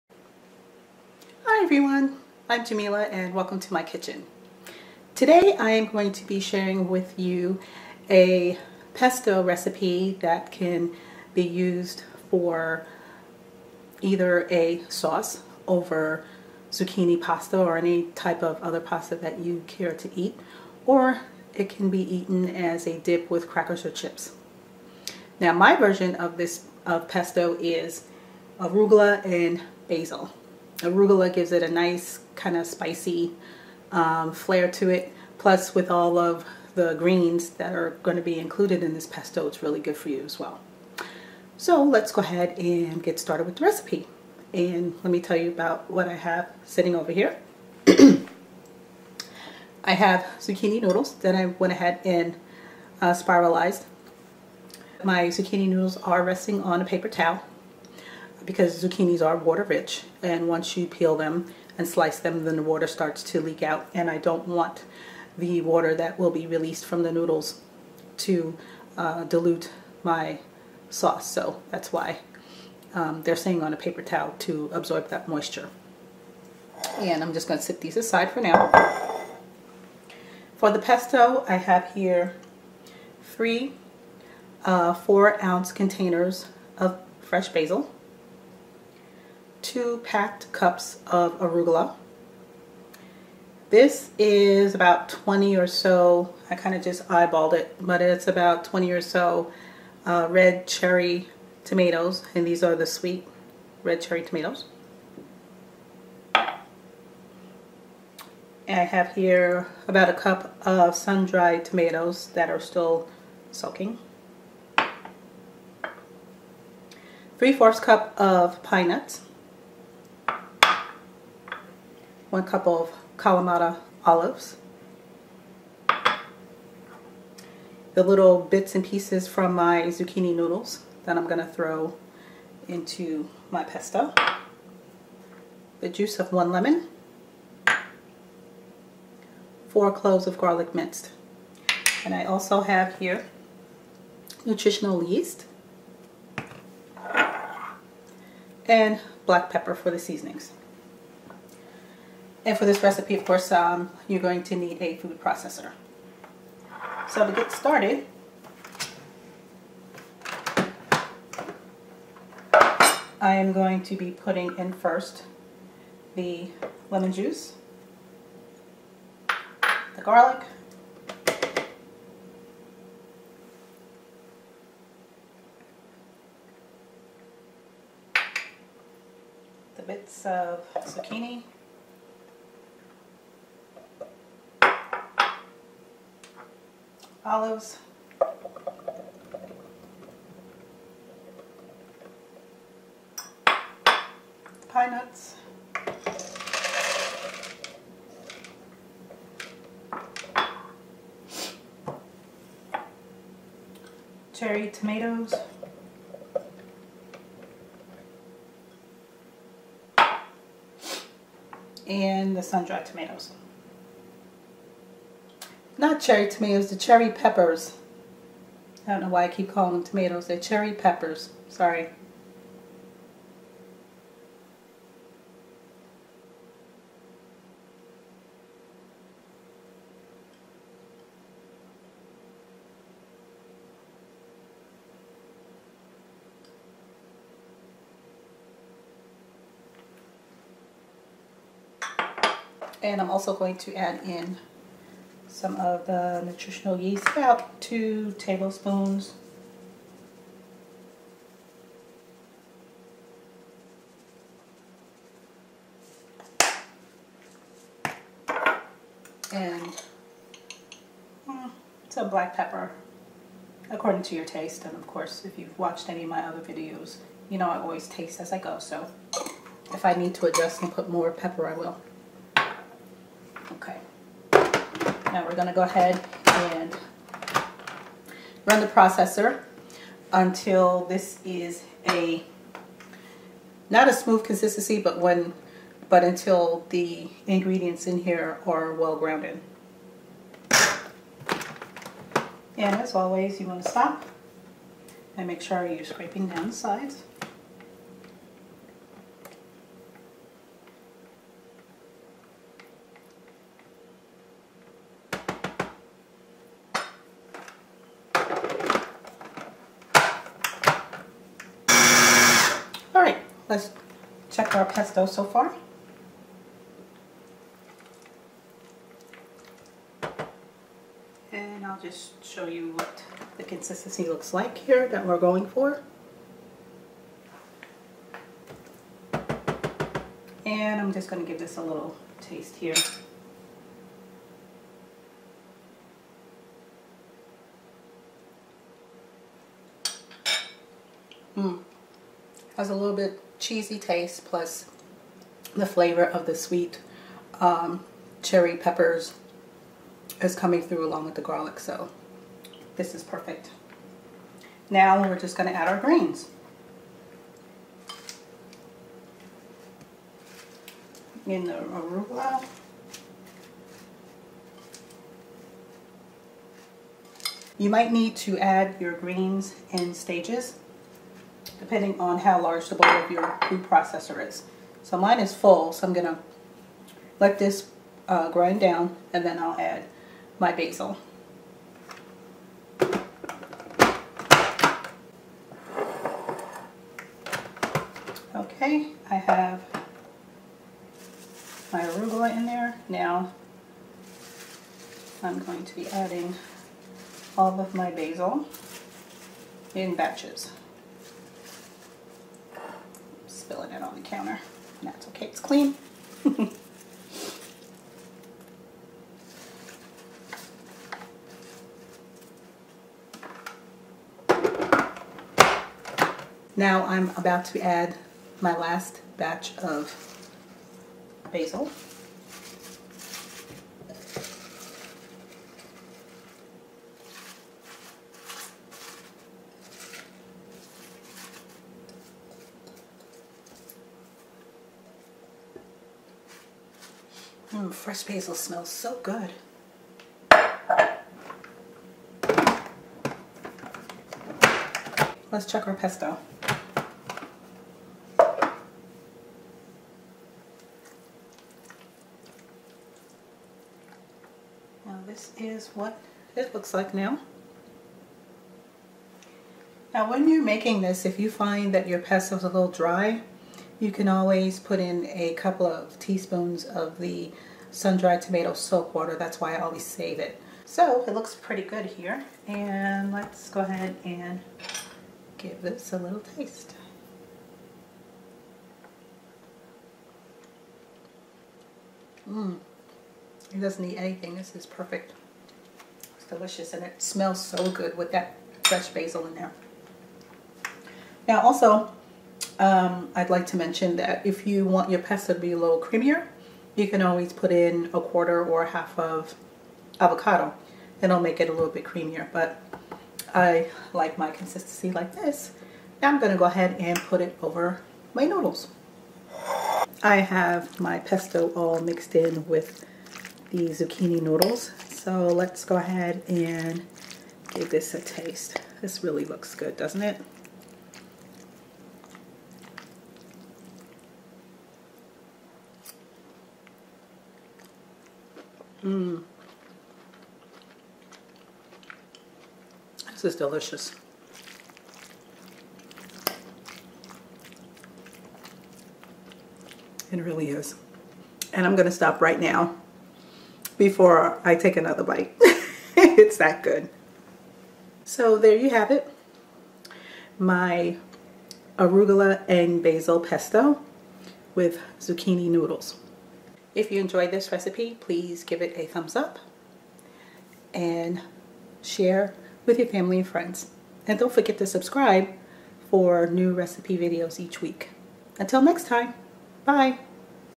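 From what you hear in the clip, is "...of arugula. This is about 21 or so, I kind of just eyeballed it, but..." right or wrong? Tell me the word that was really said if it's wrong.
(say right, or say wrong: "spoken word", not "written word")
wrong: "20", not "21".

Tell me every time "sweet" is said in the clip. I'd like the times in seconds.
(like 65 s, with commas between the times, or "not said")
102 s, 346 s.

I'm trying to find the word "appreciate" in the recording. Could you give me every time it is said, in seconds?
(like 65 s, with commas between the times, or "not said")
not said.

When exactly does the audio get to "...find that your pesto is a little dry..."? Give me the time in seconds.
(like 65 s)
461 s.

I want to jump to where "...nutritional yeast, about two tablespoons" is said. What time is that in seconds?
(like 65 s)
246 s.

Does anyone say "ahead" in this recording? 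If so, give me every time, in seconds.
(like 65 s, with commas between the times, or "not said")
42 s, 51 s, 275 s, 473 s, 506 s, 515 s.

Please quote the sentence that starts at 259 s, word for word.
And mm, some black pepper, according to your taste.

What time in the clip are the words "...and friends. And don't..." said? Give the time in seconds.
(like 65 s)
563 s.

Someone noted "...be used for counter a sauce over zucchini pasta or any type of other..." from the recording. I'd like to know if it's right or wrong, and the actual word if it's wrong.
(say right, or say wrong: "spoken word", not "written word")
wrong: "either", not "counter".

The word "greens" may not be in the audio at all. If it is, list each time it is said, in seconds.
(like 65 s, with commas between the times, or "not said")
36 s, 355 s, 368 s.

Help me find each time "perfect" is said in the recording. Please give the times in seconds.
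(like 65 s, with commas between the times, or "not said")
353 s, 484 s.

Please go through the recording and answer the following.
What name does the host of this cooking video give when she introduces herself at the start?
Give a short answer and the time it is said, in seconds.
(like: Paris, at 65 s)
Jameelah, at 2 s.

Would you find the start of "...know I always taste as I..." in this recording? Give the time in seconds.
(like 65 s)
267 s.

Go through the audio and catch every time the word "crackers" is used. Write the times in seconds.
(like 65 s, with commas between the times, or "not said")
23 s.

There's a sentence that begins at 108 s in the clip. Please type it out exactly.
And I have here about a cup of sun-dried tomatoes that are still soaking.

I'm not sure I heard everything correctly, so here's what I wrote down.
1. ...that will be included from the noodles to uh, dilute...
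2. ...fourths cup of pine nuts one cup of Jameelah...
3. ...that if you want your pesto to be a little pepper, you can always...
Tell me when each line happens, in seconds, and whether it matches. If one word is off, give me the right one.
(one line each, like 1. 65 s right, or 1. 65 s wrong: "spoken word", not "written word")
1. 65 s wrong: "released", not "included"
2. 117 s wrong: "Kalamata", not "Jameelah"
3. 493 s wrong: "creamier", not "pepper".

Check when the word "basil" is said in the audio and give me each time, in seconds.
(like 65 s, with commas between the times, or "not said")
29 s, 87 s, 380 s, 397 s, 421 s, 438 s, 488 s, 552 s.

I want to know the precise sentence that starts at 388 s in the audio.
Okay, I have my arugula in there.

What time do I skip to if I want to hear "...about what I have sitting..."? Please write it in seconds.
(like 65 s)
45 s.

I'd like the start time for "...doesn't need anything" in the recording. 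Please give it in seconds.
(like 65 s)
483 s.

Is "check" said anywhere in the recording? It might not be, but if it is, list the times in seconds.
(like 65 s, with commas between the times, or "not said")
314 s, 445 s.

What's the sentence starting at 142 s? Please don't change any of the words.
And I also have here nutritional yeast and black pepper for the seasonings.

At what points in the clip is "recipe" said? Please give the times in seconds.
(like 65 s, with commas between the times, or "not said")
9 s, 43 s, 152 s, 557 s, 566 s.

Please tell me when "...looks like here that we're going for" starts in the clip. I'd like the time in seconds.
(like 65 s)
324 s.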